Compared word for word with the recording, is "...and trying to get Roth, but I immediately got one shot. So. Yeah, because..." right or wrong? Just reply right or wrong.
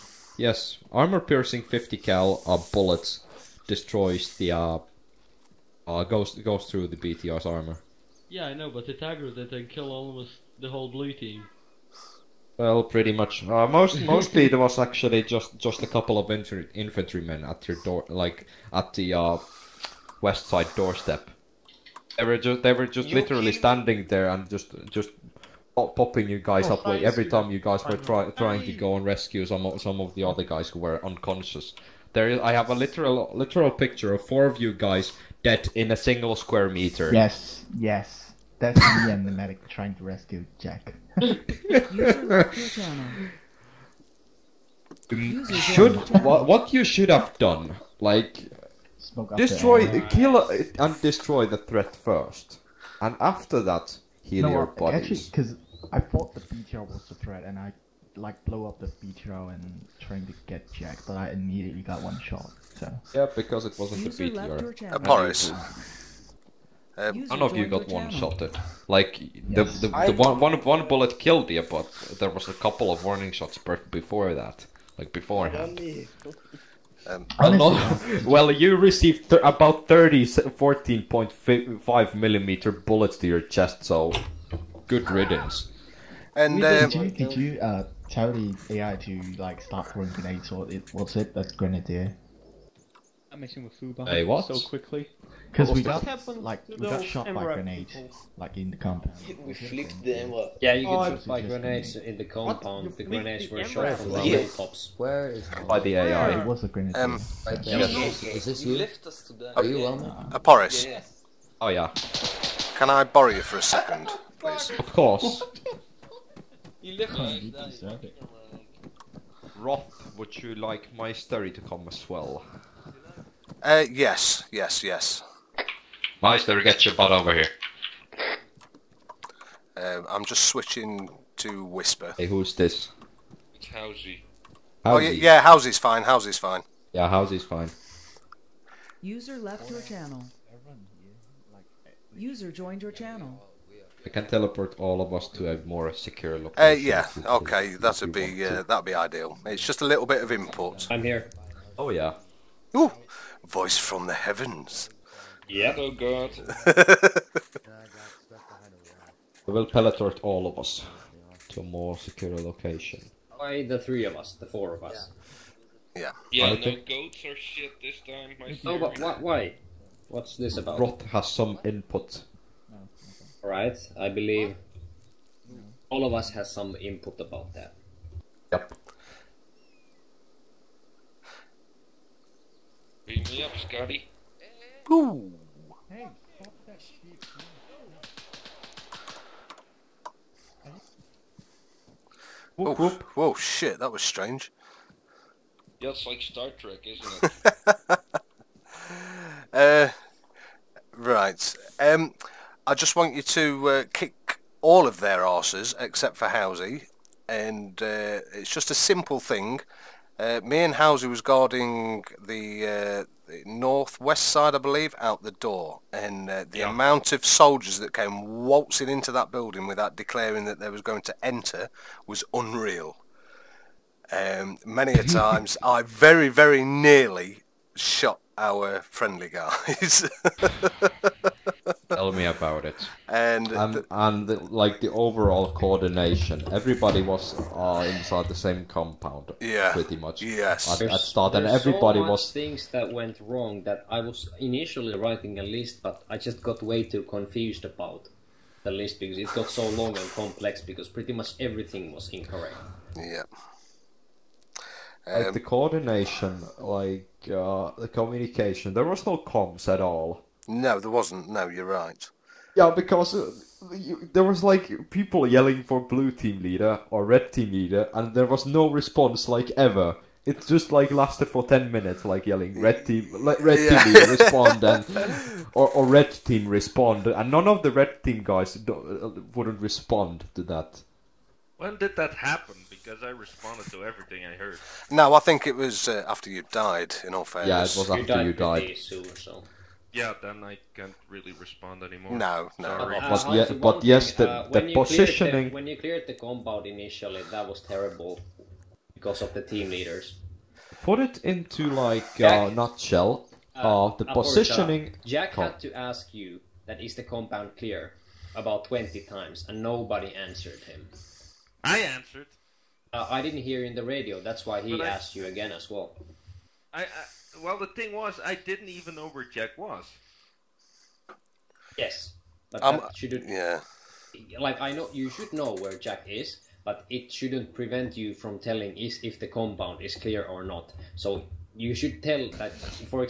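wrong.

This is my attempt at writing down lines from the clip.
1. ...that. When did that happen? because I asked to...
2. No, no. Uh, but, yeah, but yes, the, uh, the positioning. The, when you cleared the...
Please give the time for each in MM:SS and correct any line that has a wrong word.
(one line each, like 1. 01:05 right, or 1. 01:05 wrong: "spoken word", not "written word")
1. 04:40 wrong: "responded", not "asked"
2. 04:52 right.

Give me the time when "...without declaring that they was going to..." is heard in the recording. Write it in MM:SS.
03:39.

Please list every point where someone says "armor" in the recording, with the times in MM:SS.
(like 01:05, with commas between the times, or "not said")
00:00, 00:07.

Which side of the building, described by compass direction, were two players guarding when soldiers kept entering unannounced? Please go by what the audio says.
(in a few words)
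Northwest.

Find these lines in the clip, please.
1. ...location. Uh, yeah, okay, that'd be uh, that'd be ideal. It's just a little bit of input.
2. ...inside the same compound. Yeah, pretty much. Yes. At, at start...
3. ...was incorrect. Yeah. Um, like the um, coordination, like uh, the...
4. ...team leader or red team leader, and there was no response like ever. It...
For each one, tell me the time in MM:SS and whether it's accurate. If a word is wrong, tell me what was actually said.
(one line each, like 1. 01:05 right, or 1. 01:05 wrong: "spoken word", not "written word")
1. 02:26 right
2. 03:57 right
3. 04:11 right
4. 04:26 right.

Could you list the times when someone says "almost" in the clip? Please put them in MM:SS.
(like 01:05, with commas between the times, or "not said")
00:09.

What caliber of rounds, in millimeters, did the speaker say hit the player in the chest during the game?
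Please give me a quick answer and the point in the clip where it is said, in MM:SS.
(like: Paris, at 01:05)
14.5 millimeter, at 01:20.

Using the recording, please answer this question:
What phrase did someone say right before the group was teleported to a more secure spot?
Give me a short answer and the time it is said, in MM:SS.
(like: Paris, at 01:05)
Beam me up, Scotty, at 03:03.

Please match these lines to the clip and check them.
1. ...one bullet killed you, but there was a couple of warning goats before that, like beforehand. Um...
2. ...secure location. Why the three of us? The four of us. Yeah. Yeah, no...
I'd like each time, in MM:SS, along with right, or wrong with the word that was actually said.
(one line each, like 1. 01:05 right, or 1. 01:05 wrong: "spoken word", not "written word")
1. 01:10 wrong: "shots", not "goats"
2. 02:41 right.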